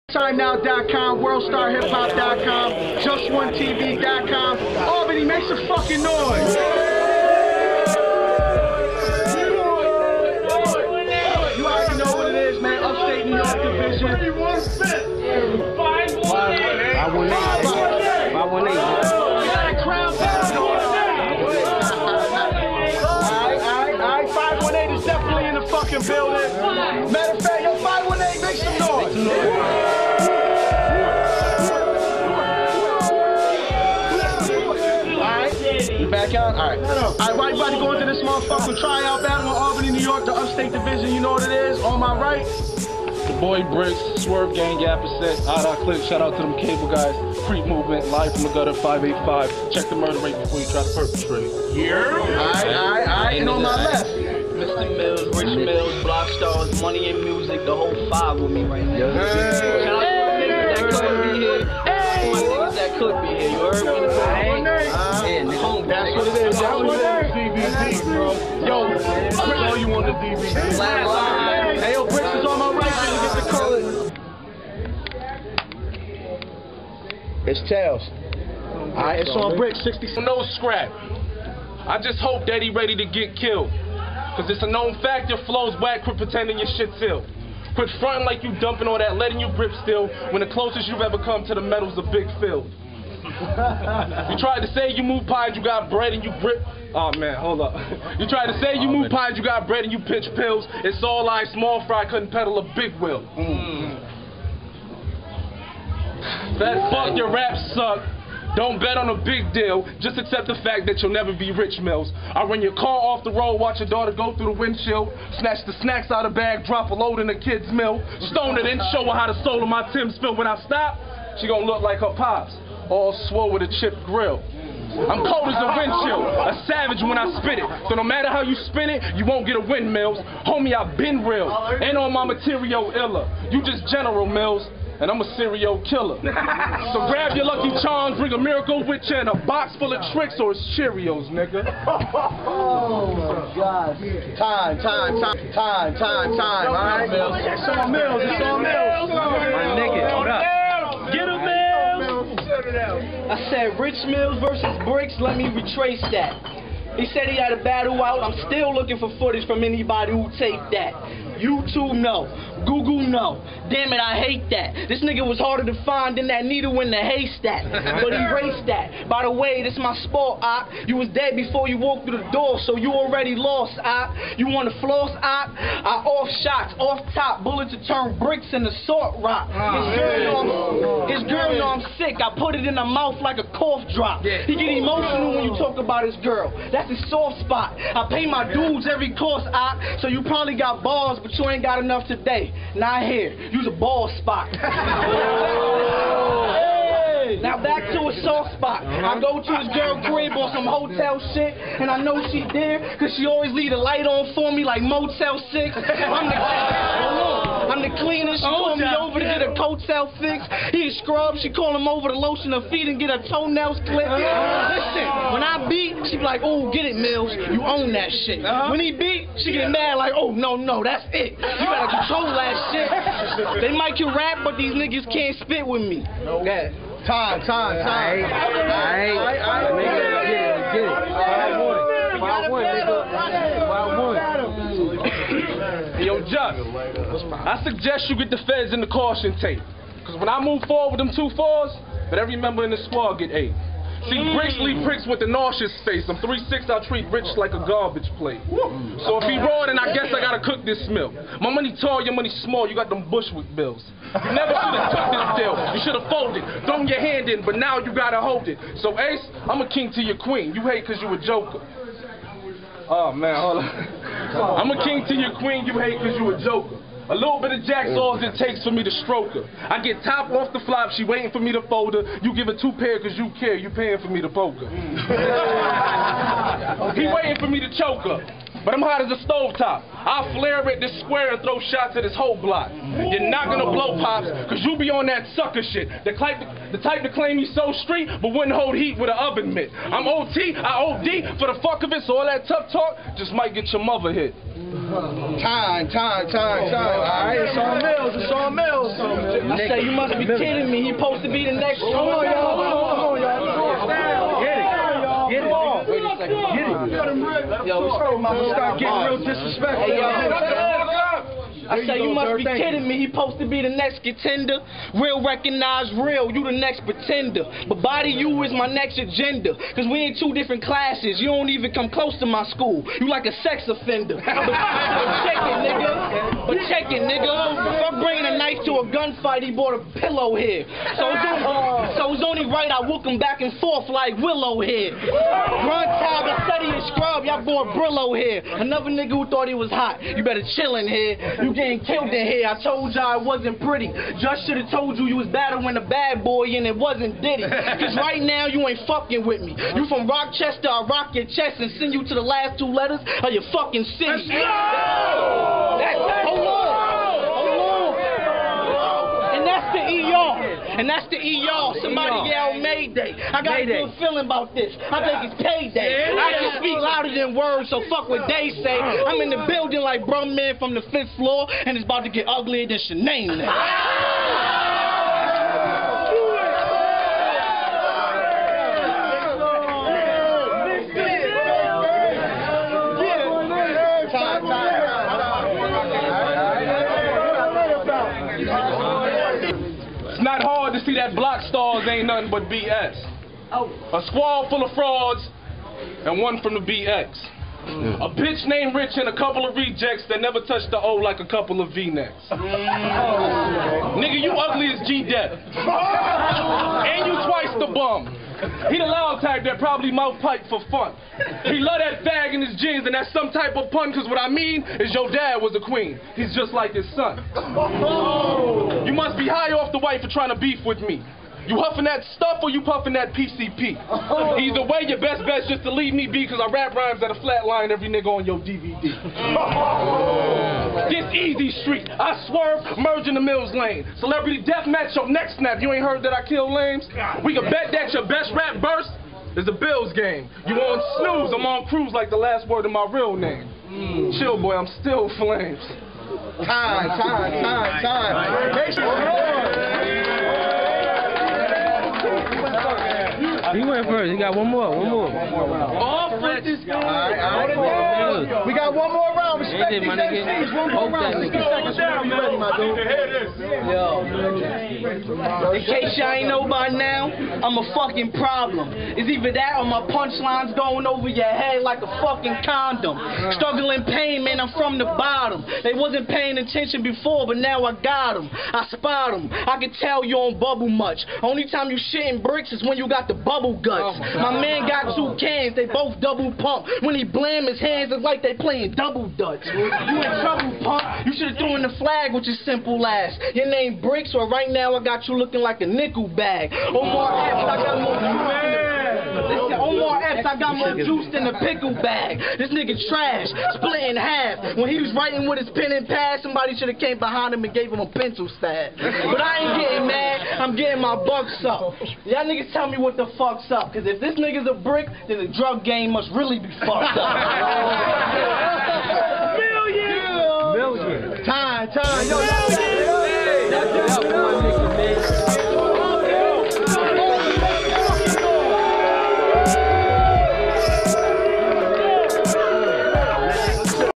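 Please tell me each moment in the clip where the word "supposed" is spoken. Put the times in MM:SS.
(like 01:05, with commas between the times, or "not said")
05:00, 05:13.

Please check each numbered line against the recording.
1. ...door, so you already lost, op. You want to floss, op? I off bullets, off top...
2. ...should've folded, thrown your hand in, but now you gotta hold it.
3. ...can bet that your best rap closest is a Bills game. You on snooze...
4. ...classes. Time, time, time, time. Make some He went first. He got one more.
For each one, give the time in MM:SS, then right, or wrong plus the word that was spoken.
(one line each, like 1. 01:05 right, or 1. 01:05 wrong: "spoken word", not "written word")
1. 02:52 wrong: "shots", not "bullets"
2. 04:15 right
3. 07:17 wrong: "burst", not "closest"
4. 07:25 wrong: "flames", not "classes".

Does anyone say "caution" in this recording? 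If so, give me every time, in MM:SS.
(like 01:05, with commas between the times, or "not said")
03:58.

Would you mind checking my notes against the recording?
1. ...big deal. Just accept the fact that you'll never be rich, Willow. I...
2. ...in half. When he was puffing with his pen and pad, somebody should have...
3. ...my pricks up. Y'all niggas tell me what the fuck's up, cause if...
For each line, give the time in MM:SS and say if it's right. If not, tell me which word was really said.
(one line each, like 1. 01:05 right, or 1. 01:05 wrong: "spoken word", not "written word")
1. 01:49 wrong: "Mills", not "Willow"
2. 08:23 wrong: "writing", not "puffing"
3. 08:30 wrong: "bucks", not "pricks".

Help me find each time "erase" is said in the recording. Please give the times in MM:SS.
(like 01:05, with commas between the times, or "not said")
02:48.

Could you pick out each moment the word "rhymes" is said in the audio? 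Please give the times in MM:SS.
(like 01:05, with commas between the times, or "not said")
07:06.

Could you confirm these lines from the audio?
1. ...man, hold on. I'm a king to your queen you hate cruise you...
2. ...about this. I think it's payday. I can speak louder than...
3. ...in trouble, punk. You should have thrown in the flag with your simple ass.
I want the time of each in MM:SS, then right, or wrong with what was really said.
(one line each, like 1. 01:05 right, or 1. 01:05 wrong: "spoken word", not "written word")
1. 04:23 wrong: "cause", not "cruise"
2. 06:04 right
3. 08:09 right.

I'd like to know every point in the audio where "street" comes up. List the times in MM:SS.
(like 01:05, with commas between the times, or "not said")
04:47, 07:11.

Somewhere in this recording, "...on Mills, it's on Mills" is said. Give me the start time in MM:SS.
04:57.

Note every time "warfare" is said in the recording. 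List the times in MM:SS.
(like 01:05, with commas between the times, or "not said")
not said.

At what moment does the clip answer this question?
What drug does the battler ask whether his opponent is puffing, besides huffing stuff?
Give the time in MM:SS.
07:03.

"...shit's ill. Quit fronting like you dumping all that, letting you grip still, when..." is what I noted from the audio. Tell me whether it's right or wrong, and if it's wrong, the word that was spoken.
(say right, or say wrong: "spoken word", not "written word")
right.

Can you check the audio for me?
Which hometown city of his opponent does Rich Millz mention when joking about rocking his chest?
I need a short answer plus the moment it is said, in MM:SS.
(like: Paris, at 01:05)
Rochester, at 05:50.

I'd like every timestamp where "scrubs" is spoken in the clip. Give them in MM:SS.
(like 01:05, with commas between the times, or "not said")
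03:31, 05:36.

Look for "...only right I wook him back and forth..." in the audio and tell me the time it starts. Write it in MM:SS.
05:32.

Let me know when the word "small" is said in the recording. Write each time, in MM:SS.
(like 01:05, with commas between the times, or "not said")
01:41, 04:12.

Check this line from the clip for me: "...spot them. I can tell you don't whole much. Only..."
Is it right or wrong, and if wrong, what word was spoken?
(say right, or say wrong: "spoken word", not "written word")
wrong: "bubble", not "whole".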